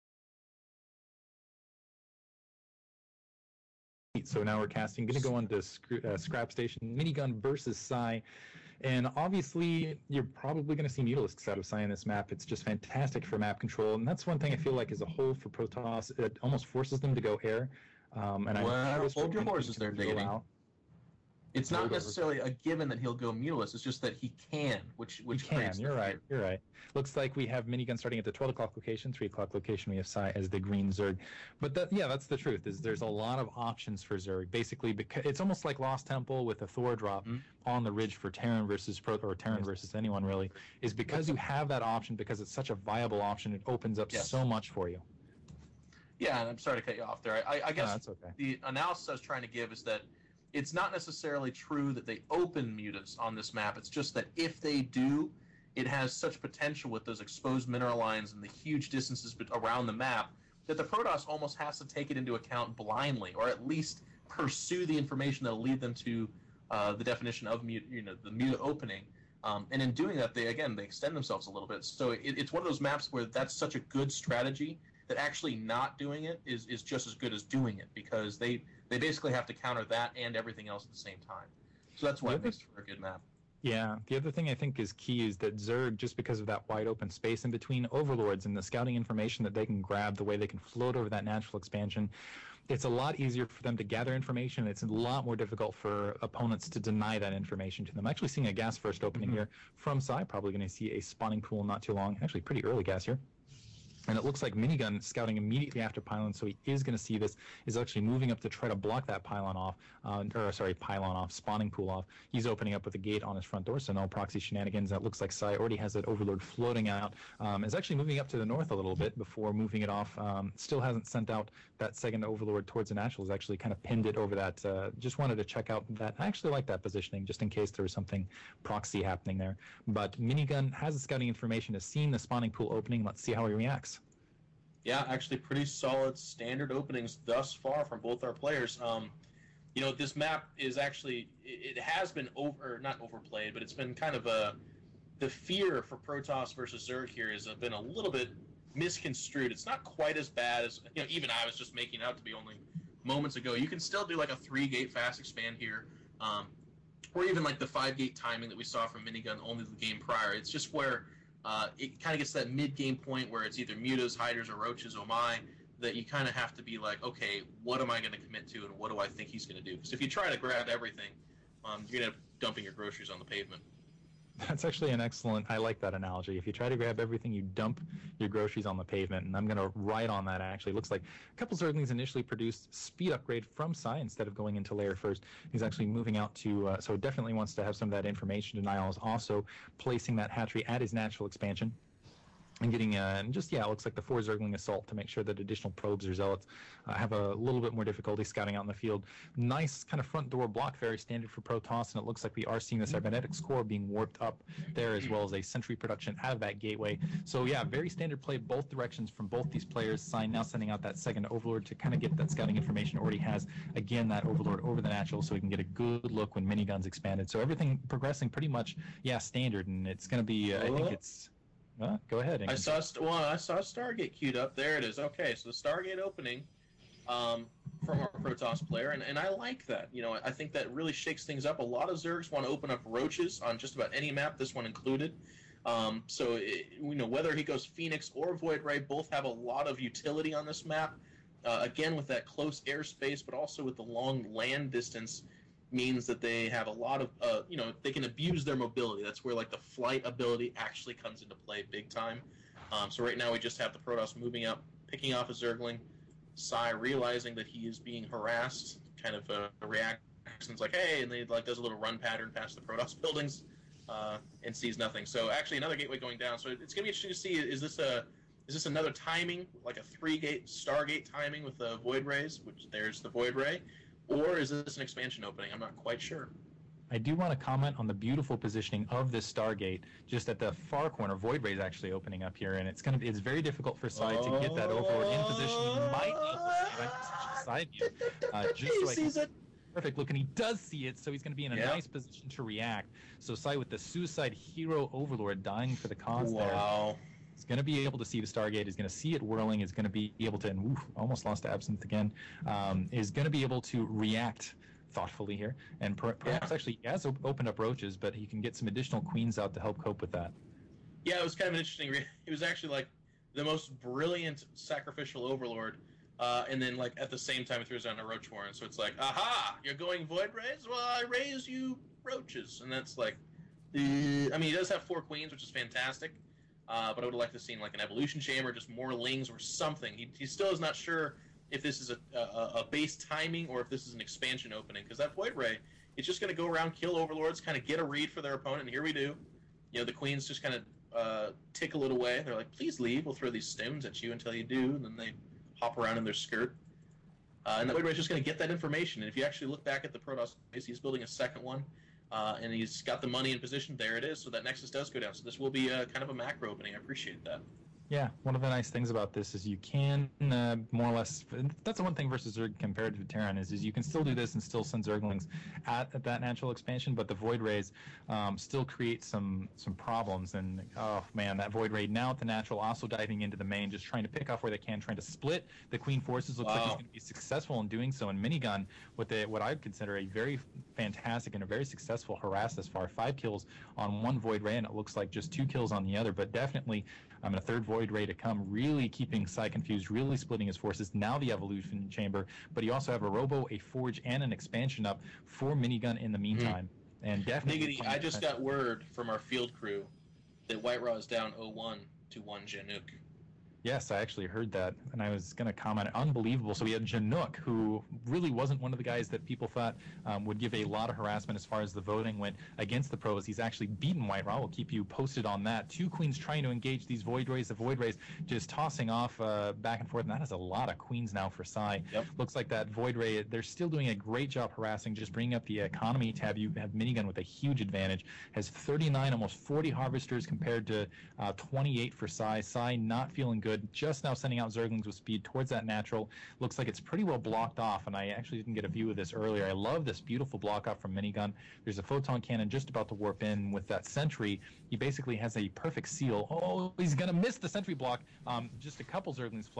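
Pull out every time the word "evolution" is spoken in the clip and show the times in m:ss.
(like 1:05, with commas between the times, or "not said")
5:27, 6:31.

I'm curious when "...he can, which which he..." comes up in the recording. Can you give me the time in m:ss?
0:24.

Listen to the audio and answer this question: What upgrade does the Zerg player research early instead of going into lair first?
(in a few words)
speed upgrade.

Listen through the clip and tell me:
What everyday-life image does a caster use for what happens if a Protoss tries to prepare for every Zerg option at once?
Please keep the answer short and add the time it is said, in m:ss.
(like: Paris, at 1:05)
dumping your groceries on the pavement, at 2:52.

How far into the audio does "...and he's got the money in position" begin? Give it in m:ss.
5:52.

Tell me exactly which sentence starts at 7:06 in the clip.
You have minigun with a huge advantage.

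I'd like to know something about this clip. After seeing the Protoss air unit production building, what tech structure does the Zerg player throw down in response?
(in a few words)
roach warren.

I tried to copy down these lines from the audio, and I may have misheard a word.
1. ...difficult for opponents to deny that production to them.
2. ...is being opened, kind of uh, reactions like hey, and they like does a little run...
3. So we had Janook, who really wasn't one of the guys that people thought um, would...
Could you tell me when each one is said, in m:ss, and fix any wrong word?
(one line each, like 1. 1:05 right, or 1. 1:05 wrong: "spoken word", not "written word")
1. 1:35 wrong: "information", not "production"
2. 4:17 wrong: "harassed", not "opened"
3. 6:46 right.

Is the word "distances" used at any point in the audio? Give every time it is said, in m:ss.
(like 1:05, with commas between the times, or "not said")
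0:58, 4:04.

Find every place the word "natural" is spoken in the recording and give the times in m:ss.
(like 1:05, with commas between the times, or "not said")
1:31, 3:10, 3:34, 6:06, 6:12, 7:15.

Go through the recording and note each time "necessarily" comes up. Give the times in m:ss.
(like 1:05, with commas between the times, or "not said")
0:21, 0:50.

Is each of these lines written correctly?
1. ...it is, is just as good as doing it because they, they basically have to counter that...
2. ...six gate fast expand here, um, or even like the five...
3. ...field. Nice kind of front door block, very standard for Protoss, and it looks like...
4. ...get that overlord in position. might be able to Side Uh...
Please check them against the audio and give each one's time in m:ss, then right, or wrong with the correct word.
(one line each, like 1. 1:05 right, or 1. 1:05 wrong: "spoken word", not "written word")
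1. 1:16 right
2. 2:34 wrong: "three", not "six"
3. 3:18 right
4. 4:44 right.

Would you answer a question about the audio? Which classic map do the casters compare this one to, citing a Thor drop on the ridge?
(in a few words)
Lost Temple.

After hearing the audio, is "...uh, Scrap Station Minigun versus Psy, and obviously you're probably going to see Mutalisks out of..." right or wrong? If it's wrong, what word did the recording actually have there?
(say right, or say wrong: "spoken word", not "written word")
right.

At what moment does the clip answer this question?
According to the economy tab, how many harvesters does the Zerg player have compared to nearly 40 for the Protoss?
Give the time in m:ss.
7:11.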